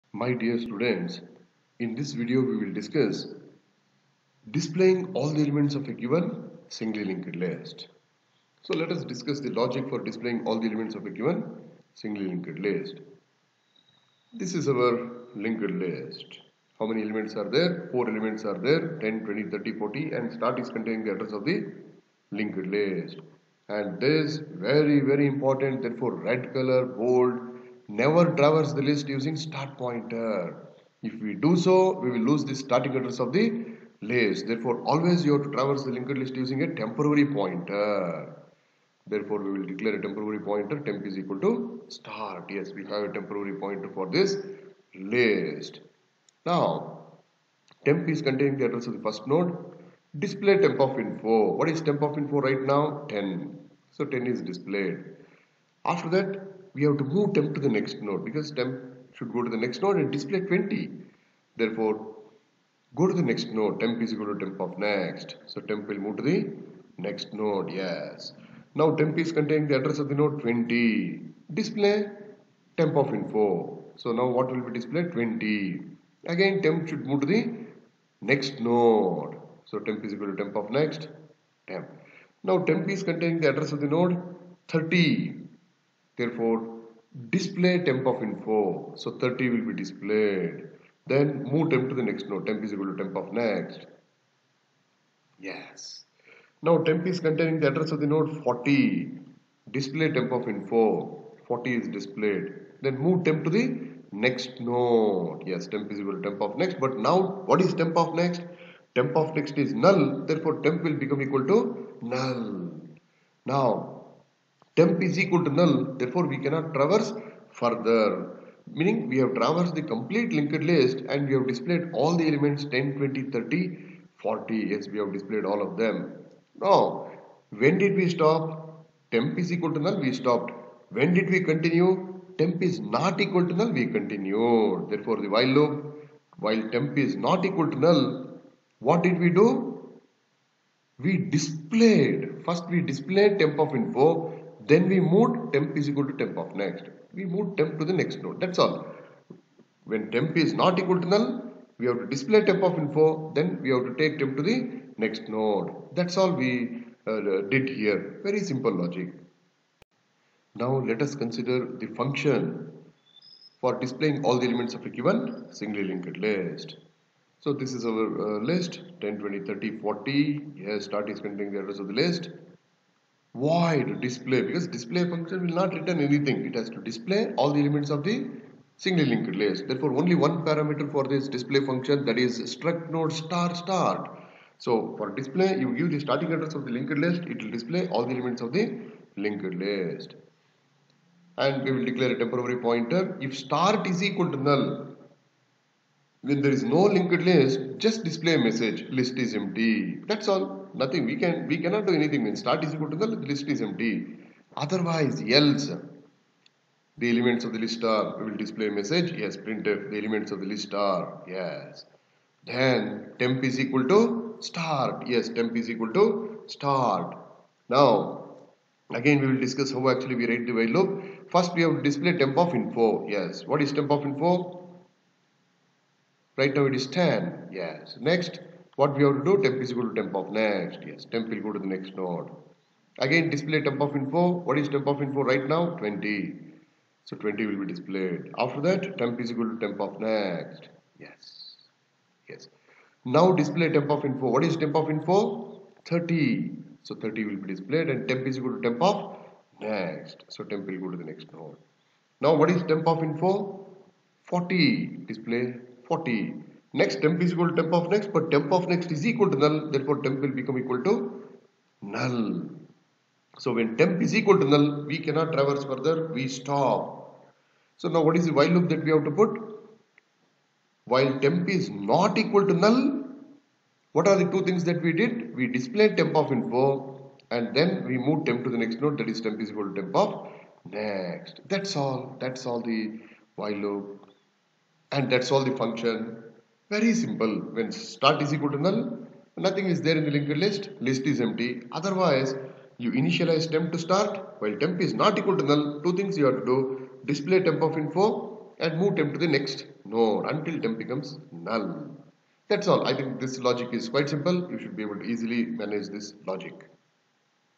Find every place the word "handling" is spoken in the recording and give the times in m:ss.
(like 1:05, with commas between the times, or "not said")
not said.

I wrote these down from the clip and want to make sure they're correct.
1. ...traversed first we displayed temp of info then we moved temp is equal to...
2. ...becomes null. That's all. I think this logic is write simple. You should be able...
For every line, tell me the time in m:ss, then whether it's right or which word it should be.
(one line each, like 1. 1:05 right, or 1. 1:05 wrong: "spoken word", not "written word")
1. 2:21 wrong: "displayed", not "traversed"
2. 5:00 wrong: "quite", not "write".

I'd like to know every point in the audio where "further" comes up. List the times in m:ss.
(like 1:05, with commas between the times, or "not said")
1:57, 4:25.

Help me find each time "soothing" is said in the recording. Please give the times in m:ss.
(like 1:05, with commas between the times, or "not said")
not said.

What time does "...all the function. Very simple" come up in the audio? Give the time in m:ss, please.
4:45.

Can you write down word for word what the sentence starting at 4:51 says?
Otherwise, you initialize temp to start.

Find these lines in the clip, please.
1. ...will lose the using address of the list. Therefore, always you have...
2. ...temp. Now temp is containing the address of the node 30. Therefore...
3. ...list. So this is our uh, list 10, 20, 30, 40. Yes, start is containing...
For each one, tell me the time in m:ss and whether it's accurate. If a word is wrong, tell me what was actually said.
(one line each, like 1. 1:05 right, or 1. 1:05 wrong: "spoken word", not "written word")
1. 0:32 wrong: "starting", not "using"
2. 1:21 right
3. 2:46 right.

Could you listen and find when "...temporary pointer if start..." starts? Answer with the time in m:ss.
3:12.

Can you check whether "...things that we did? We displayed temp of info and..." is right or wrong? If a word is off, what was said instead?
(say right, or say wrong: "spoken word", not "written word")
right.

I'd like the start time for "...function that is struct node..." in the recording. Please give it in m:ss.
3:01.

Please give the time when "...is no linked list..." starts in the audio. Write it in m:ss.
3:16.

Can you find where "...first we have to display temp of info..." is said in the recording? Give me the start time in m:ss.
3:41.